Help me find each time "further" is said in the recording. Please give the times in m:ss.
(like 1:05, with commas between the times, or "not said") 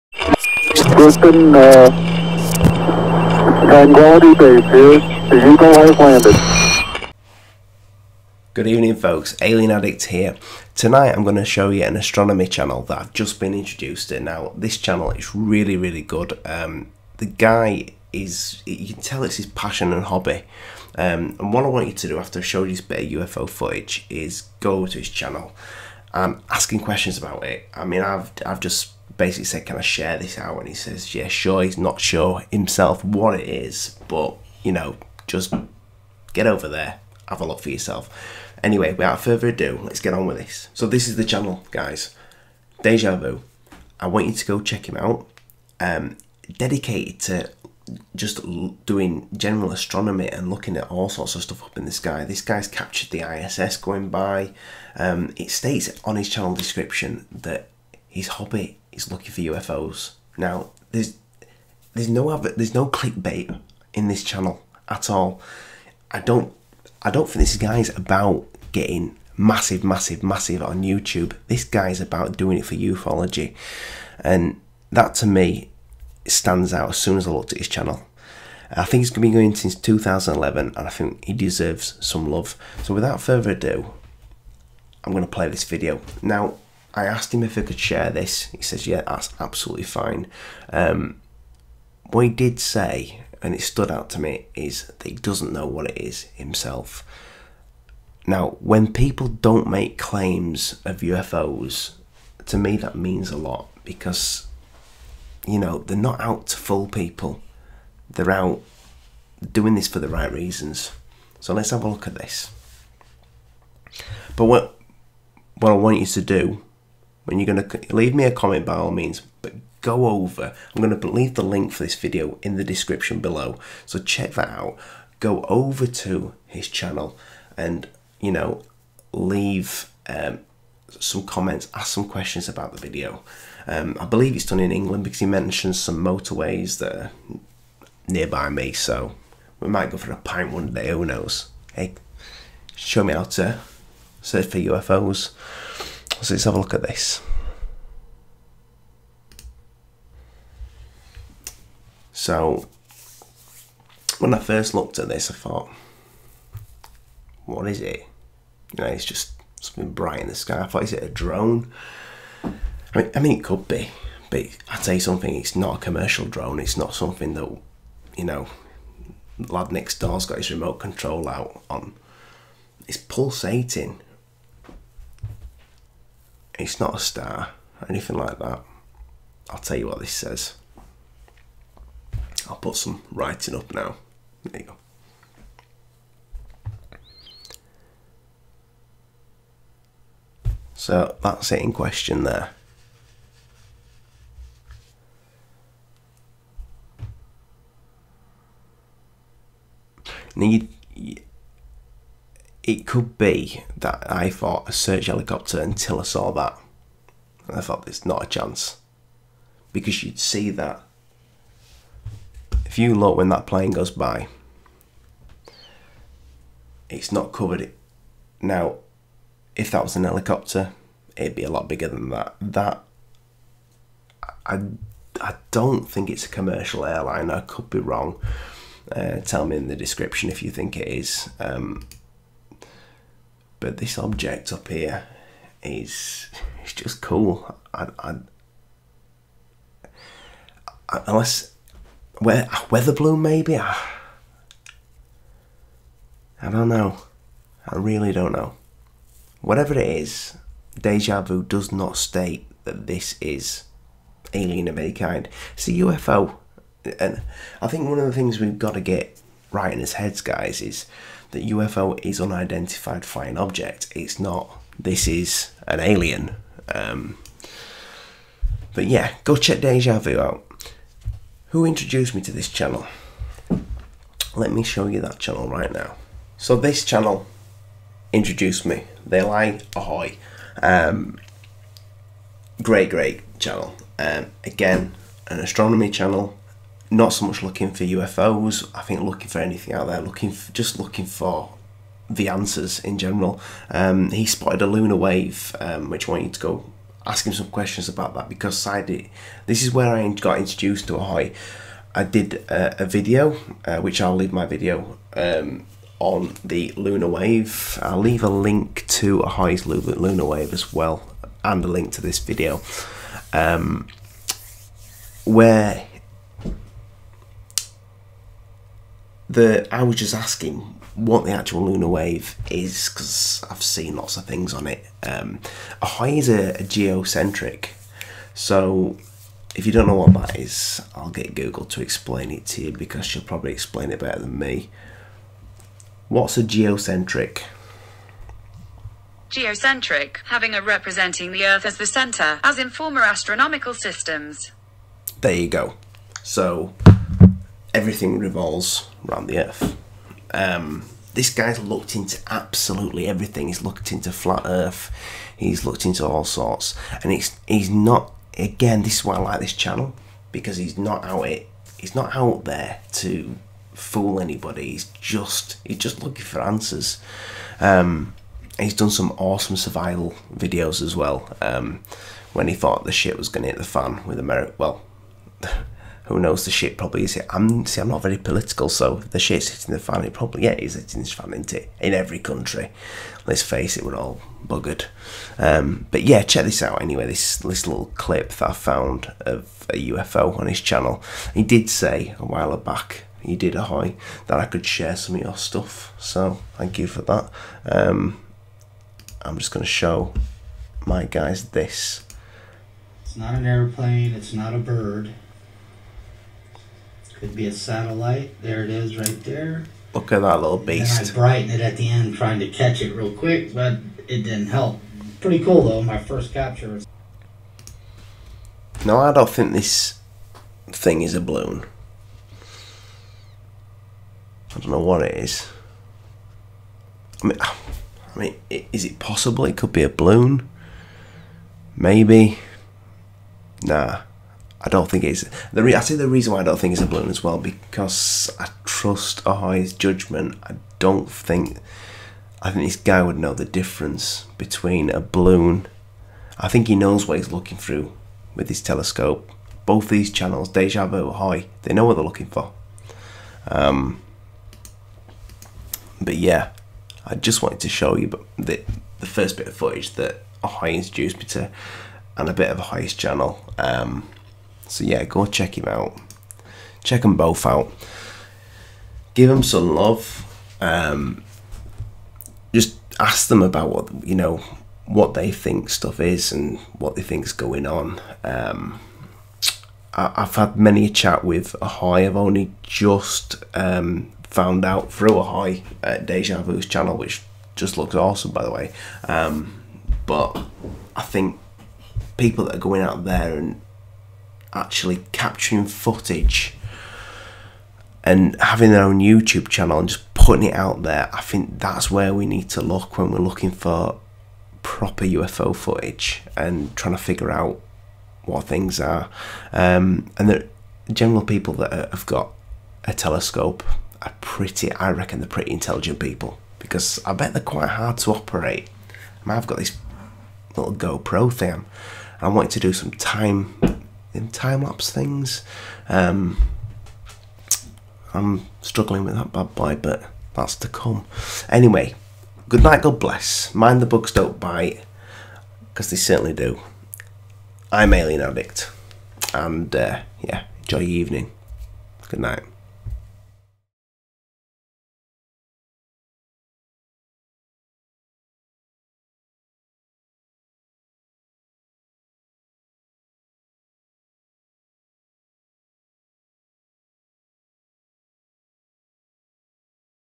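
0:39, 1:23.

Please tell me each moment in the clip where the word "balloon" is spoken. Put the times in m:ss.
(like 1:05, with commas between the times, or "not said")
4:02, 7:01, 7:09, 7:16, 7:24.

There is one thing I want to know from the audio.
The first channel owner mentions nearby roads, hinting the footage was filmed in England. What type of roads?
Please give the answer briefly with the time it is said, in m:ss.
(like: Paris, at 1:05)
Motorways, at 2:16.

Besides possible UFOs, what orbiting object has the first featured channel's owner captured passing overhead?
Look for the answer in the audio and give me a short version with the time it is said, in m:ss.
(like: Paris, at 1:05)
The ISS, at 0:53.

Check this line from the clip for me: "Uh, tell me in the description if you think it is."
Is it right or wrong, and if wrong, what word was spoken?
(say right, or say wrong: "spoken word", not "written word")
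right.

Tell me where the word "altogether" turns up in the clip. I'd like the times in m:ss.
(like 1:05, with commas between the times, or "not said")
not said.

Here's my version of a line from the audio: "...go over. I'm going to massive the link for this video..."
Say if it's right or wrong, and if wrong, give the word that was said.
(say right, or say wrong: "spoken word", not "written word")
wrong: "leave", not "massive".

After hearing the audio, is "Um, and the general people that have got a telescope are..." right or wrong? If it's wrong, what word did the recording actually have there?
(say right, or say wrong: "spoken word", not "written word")
right.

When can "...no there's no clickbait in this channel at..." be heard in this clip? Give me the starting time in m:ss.
1:02.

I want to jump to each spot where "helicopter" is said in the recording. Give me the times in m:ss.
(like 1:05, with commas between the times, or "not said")
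3:25, 3:40.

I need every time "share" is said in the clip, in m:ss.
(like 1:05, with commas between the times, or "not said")
0:29, 1:27, 6:34.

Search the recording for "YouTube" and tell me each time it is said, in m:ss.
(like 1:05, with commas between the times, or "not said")
1:10, 8:18.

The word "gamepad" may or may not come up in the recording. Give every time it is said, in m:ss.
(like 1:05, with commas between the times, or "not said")
not said.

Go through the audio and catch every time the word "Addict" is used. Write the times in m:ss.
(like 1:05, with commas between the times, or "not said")
0:09, 8:58.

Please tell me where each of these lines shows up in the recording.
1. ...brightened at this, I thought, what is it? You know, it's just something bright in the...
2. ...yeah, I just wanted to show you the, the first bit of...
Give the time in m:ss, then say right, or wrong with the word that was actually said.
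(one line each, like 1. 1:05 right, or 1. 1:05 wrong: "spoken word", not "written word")
1. 2:34 wrong: "looked", not "brightened"
2. 7:36 right.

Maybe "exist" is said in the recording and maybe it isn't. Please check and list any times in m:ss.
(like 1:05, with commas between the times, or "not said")
not said.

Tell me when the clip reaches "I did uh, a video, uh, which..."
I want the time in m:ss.
5:01.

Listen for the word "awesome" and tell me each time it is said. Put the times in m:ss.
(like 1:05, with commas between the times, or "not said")
6:09, 8:07.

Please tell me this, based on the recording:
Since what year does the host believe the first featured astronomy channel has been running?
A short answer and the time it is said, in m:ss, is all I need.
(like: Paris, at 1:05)
2011, at 1:19.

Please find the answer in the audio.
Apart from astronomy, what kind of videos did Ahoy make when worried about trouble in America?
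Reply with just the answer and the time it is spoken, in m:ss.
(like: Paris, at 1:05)
Survival videos, at 6:09.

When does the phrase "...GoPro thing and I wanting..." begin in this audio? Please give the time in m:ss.
8:40.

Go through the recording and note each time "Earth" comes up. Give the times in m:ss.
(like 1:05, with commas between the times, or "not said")
5:41, 5:49, 5:54.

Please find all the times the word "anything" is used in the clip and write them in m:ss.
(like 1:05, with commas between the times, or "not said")
2:57, 4:49.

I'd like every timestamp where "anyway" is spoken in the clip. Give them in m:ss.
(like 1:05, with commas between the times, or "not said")
0:38, 6:26, 8:51.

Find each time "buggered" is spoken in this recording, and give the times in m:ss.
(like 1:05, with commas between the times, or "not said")
6:24.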